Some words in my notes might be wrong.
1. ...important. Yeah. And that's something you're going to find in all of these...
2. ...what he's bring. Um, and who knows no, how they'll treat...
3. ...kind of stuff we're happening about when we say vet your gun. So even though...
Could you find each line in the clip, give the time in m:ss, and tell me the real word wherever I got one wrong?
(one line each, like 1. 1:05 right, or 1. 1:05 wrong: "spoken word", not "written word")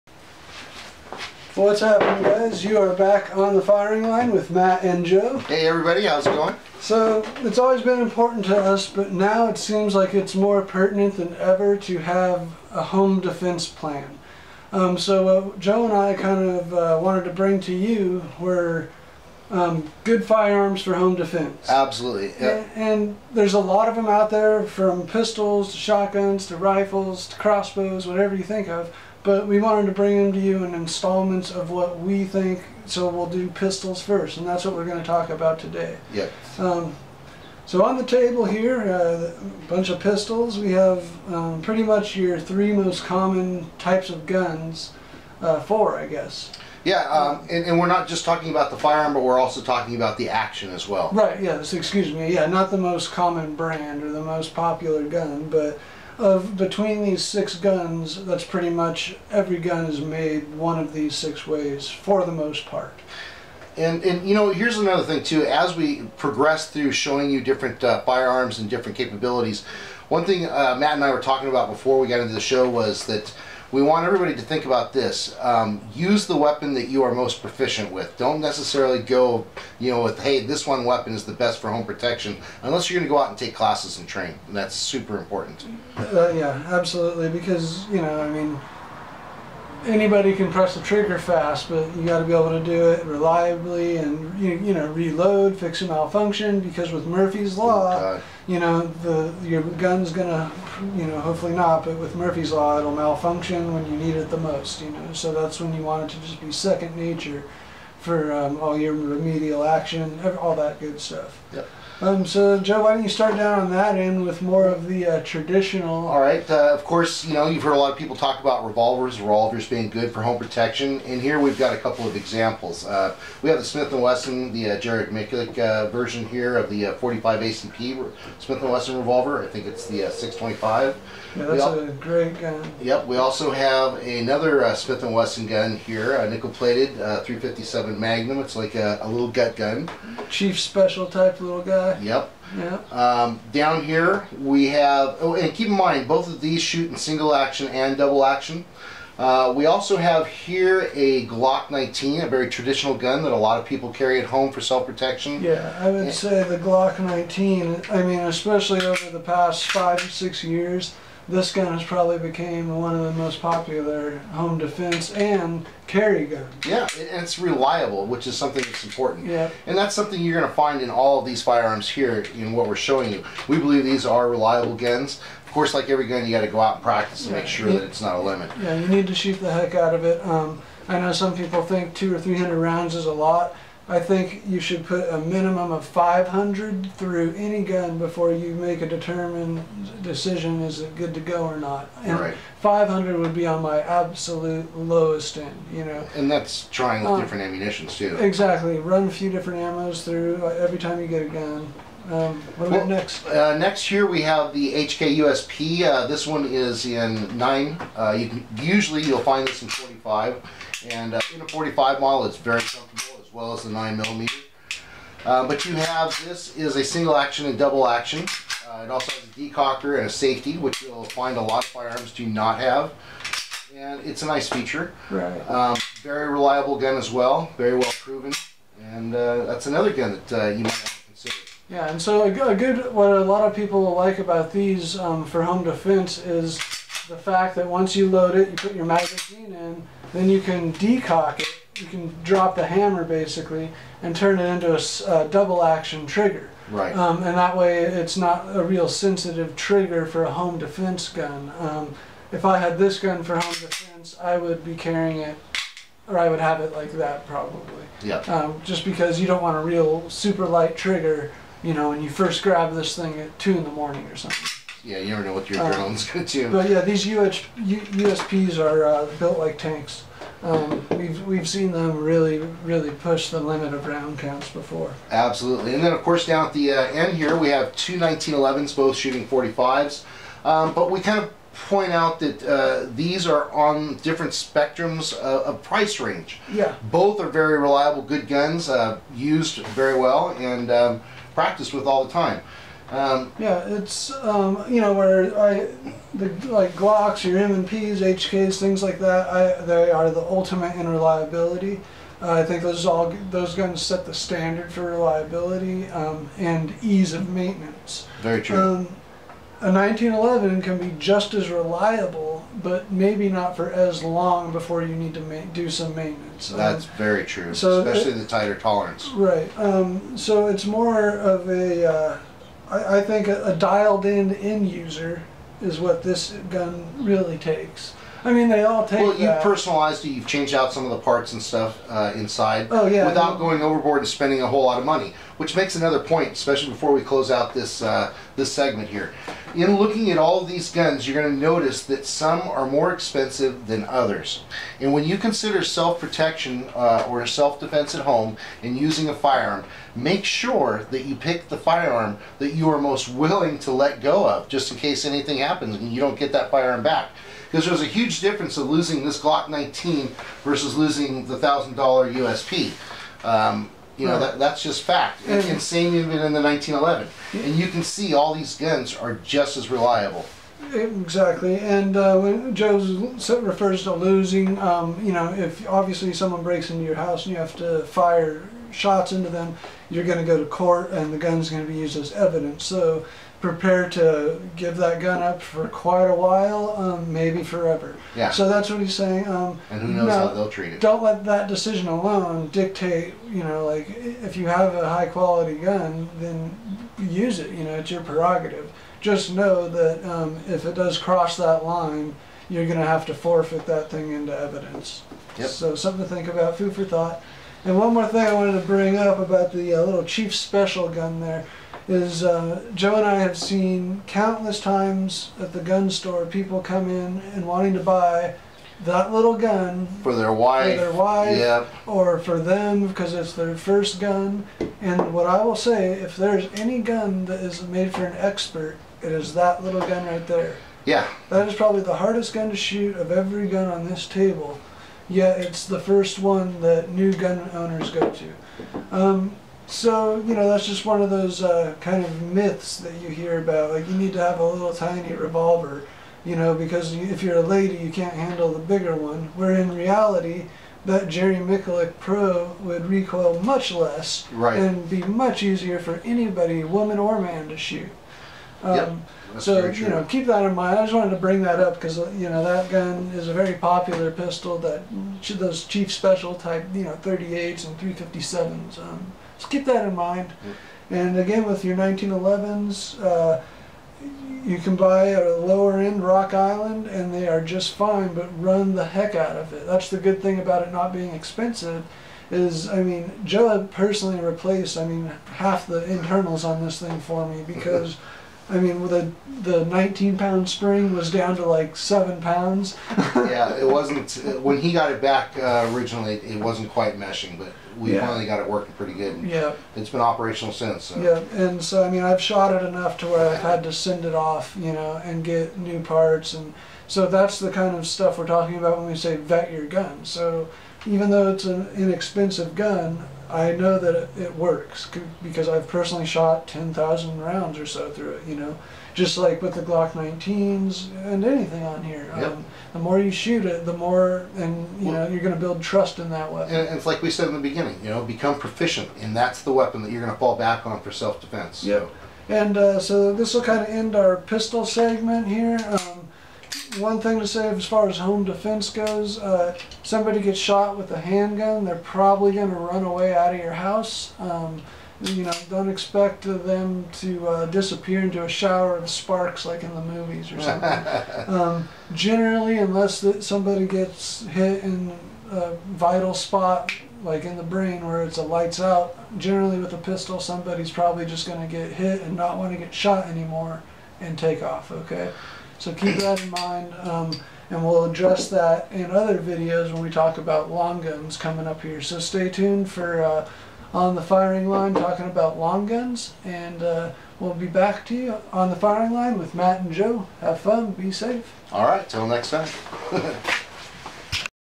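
1. 2:48 right
2. 6:28 wrong: "saying", not "bring"
3. 8:27 wrong: "talking", not "happening".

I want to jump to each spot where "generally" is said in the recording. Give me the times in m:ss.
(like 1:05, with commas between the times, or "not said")
9:11, 9:19.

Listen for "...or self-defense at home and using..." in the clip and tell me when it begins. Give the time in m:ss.
5:47.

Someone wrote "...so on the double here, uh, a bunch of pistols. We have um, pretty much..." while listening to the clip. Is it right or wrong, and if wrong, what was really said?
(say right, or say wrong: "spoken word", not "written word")
wrong: "table", not "double".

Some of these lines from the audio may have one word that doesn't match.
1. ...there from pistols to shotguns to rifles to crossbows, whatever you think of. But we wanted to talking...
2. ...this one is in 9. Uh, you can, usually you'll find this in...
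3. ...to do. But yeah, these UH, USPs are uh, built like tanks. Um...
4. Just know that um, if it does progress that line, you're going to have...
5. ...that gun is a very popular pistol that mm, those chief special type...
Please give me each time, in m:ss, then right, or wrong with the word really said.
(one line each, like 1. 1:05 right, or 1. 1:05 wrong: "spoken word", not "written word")
1. 0:24 wrong: "bring", not "talking"
2. 3:26 right
3. 4:26 right
4. 6:39 wrong: "cross", not "progress"
5. 7:42 right.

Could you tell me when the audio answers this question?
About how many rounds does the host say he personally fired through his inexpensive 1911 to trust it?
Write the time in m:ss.
8:36.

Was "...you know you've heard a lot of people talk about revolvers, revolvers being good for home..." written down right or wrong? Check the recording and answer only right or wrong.
right.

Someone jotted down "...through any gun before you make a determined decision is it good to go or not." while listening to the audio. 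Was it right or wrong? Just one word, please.
right.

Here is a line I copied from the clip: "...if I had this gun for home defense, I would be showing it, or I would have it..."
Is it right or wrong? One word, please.
wrong.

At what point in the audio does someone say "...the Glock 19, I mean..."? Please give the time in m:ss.
2:36.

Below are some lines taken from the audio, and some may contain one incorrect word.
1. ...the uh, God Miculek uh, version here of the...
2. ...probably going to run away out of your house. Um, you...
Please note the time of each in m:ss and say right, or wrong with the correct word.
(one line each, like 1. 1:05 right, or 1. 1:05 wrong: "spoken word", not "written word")
1. 2:04 wrong: "Jared", not "God"
2. 9:01 right.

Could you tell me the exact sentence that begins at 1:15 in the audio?
Um, use the weapon that you are most proficient with.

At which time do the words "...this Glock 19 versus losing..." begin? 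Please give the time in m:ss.
5:59.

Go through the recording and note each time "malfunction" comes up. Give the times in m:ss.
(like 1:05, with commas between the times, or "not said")
1:35, 1:42.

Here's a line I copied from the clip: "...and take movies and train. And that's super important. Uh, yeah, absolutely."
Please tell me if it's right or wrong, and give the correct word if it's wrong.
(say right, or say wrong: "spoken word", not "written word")
wrong: "classes", not "movies".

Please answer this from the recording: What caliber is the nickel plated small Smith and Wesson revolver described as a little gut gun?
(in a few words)
357 Magnum.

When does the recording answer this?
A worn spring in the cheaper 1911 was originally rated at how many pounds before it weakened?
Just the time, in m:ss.
8:09.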